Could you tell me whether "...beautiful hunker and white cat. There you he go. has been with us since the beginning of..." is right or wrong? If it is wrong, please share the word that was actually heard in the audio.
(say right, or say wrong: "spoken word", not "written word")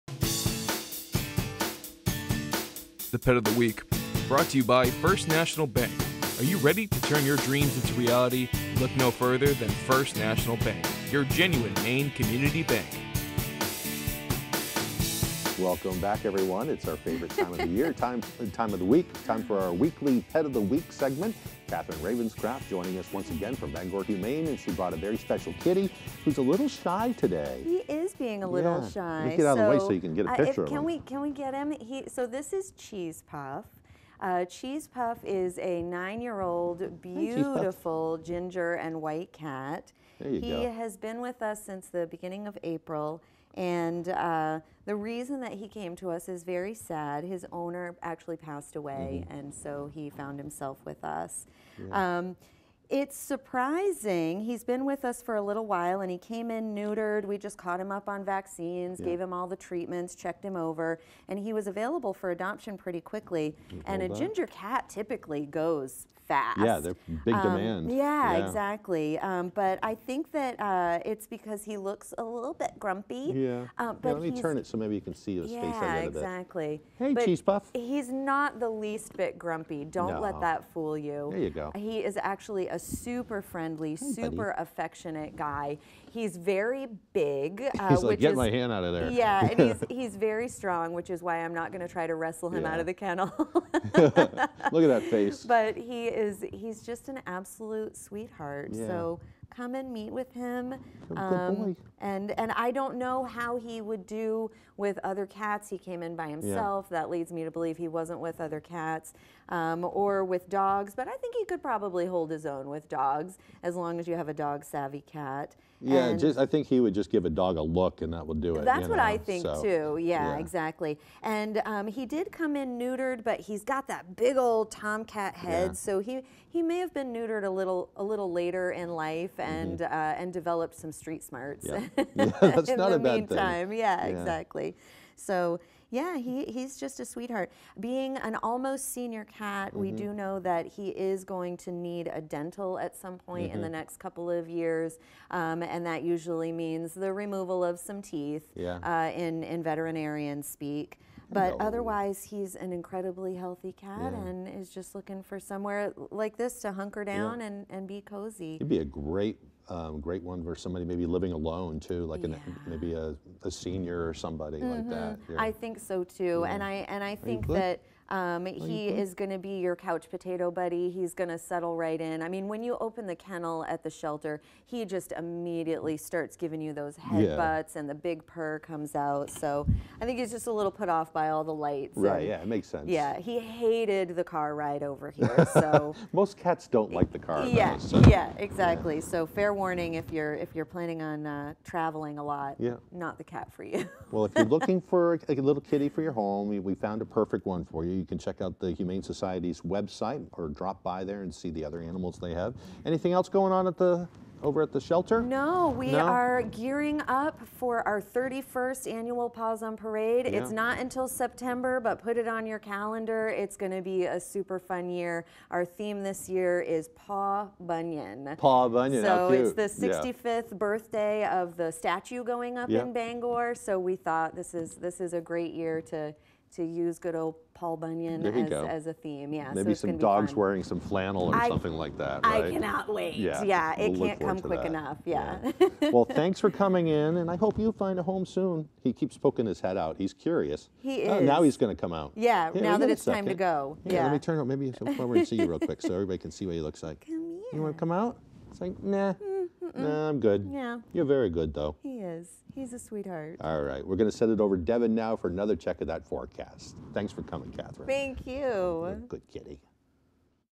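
wrong: "ginger", not "hunker".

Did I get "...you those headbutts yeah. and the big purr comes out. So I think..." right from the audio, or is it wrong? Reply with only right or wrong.
right.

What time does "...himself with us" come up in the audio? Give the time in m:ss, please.
0:50.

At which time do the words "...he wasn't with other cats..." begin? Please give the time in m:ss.
1:47.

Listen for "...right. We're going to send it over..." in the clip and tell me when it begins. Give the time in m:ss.
4:13.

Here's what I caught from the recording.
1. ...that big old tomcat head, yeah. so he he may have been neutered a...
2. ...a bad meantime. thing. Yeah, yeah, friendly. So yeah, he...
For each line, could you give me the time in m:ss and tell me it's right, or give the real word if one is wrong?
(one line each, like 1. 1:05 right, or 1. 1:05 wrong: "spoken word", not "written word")
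1. 2:03 right
2. 2:12 wrong: "exactly", not "friendly".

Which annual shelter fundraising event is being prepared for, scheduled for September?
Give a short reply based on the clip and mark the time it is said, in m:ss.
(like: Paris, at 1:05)
Paws on Parade, at 3:29.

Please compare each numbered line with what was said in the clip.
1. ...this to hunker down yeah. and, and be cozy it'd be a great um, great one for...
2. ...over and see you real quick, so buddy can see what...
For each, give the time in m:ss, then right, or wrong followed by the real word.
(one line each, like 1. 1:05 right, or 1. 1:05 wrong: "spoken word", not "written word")
1. 2:36 right
2. 4:04 wrong: "everybody", not "buddy".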